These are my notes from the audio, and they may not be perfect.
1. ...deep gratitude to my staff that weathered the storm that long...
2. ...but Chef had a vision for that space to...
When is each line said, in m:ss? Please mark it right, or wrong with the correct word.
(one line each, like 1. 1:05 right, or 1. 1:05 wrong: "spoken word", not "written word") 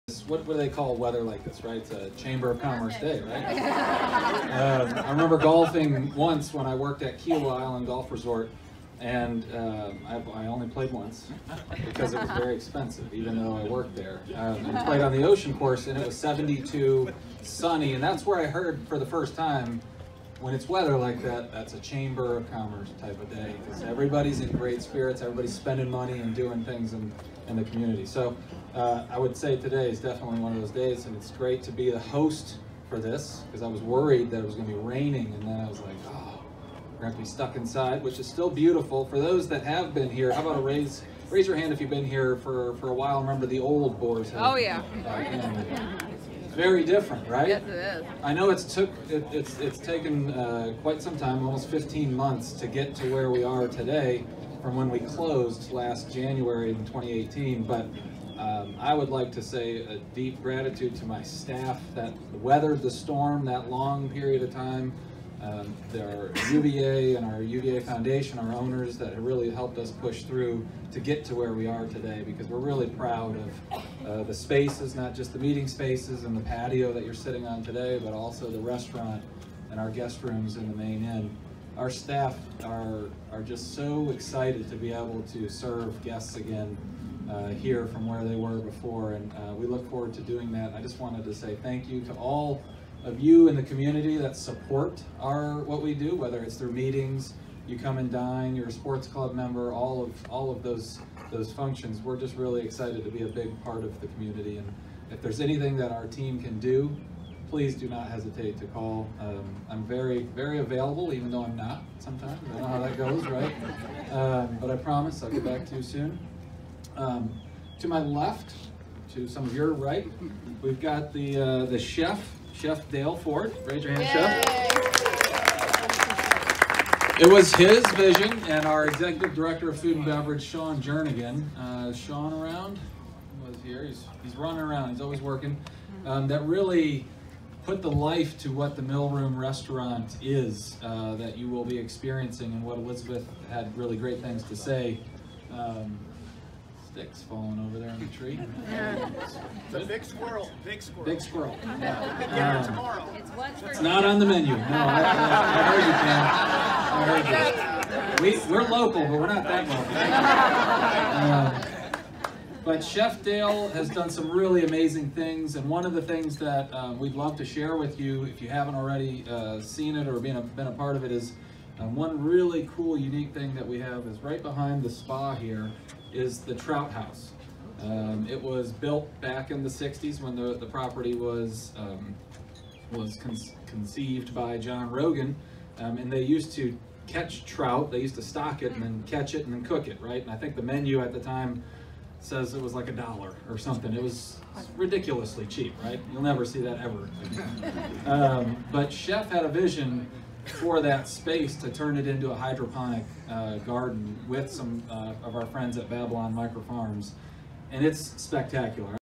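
1. 1:00 right
2. 3:18 right.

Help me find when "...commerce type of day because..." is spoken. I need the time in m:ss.
0:22.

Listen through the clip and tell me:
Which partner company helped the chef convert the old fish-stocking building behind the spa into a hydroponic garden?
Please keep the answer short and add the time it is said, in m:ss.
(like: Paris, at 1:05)
Babylon Micro Farms, at 3:25.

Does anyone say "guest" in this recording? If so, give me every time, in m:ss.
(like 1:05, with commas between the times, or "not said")
1:19, 1:26.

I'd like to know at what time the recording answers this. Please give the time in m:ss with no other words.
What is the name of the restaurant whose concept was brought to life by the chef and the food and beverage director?
2:18.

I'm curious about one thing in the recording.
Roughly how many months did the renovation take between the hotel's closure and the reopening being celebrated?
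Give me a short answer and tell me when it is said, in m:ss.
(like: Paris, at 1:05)
15 months, at 0:51.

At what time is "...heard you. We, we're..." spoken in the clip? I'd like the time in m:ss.
2:37.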